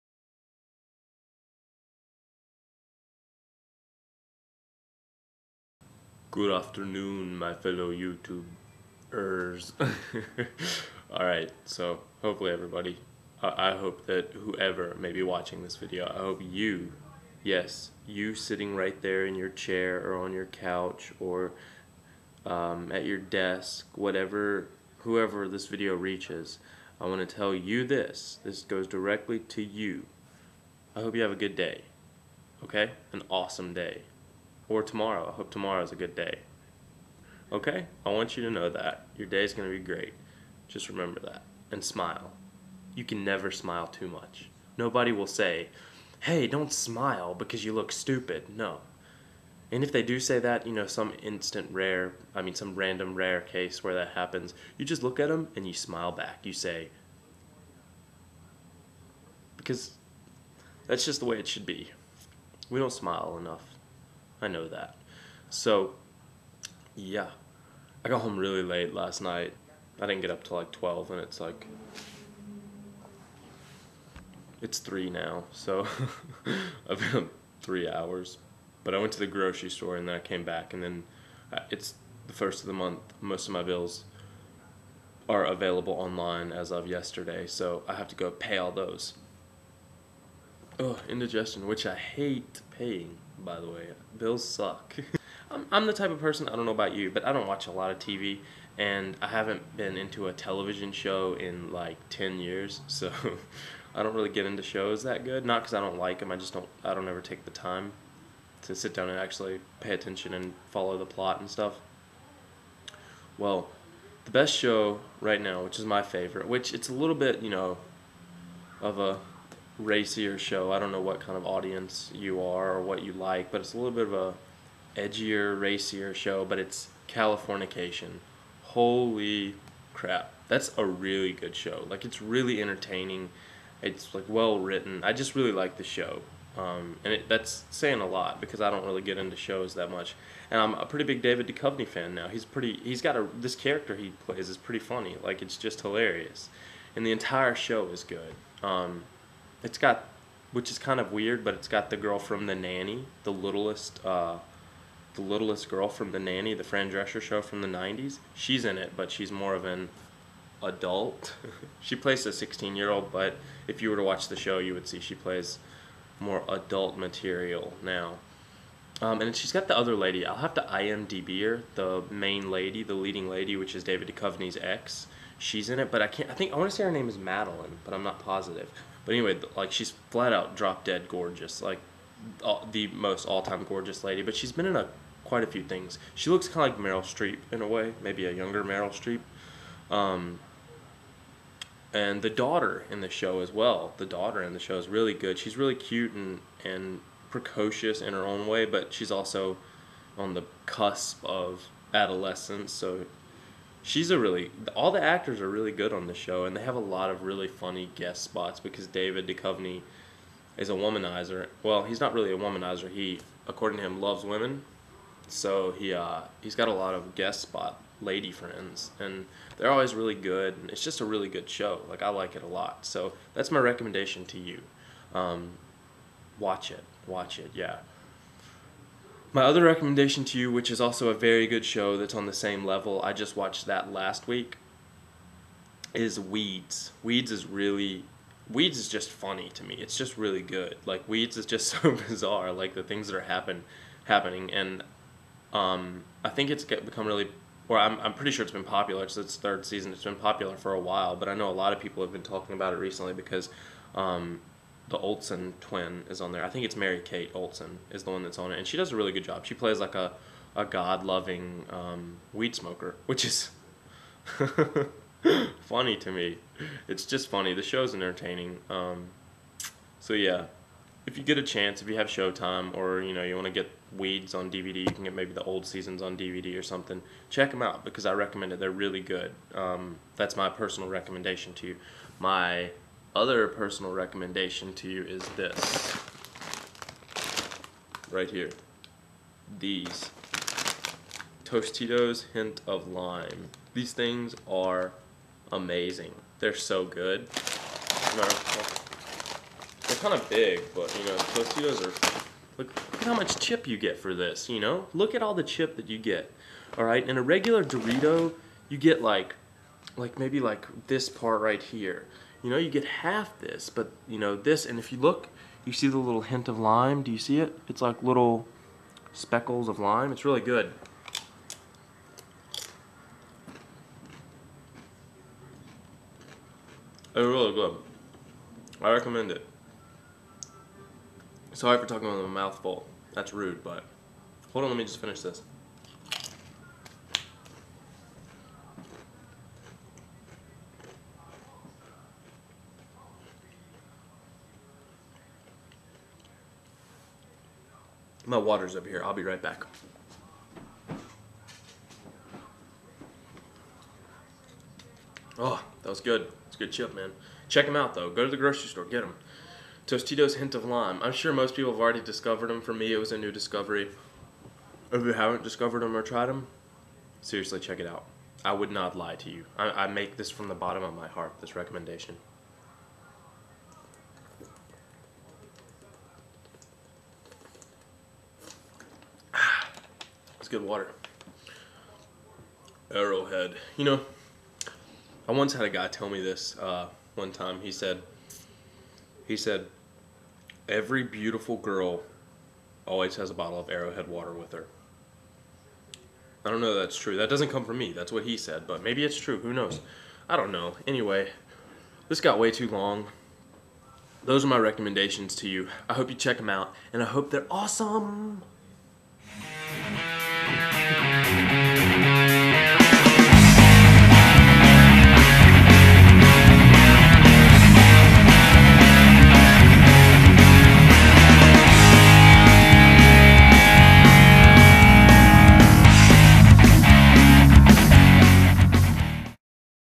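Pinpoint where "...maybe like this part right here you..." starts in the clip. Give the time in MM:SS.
05:10.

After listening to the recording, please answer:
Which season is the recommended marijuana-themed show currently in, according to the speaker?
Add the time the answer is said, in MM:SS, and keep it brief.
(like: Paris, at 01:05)
Third, at 04:09.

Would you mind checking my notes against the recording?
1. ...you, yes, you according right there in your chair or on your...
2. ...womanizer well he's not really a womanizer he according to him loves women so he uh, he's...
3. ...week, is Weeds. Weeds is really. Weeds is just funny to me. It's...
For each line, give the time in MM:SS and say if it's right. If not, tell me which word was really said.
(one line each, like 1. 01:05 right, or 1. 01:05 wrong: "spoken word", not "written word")
1. 00:16 wrong: "sitting", not "according"
2. 03:30 right
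3. 03:54 right.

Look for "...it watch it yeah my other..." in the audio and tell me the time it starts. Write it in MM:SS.
03:46.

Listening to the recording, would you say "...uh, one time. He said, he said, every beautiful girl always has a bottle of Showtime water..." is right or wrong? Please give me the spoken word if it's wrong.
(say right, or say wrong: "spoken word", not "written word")
wrong: "Arrowhead", not "Showtime".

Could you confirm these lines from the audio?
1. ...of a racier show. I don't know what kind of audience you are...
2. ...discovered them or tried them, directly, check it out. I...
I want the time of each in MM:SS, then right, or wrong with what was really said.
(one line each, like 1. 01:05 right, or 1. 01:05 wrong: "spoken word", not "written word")
1. 01:58 right
2. 06:05 wrong: "seriously", not "directly".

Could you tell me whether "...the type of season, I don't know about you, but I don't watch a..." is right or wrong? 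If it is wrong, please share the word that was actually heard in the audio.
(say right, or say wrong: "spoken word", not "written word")
wrong: "person", not "season".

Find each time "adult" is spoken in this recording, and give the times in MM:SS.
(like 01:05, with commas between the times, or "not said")
02:40, 02:46.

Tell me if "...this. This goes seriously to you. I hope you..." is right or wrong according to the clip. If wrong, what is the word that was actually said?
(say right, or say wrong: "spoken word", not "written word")
wrong: "directly", not "seriously".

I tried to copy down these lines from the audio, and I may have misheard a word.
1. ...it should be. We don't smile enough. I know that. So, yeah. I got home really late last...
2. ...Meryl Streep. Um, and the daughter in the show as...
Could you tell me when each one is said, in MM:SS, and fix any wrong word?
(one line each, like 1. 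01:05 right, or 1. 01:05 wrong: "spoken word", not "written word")
1. 01:01 right
2. 03:08 right.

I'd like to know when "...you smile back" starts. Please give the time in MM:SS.
00:55.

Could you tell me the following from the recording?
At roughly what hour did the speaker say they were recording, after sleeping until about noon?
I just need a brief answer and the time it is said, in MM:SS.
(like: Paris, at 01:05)
3, at 01:14.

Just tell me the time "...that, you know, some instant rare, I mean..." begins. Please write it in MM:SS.
00:50.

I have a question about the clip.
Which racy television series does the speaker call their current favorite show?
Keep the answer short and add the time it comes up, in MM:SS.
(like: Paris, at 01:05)
Californication, at 02:07.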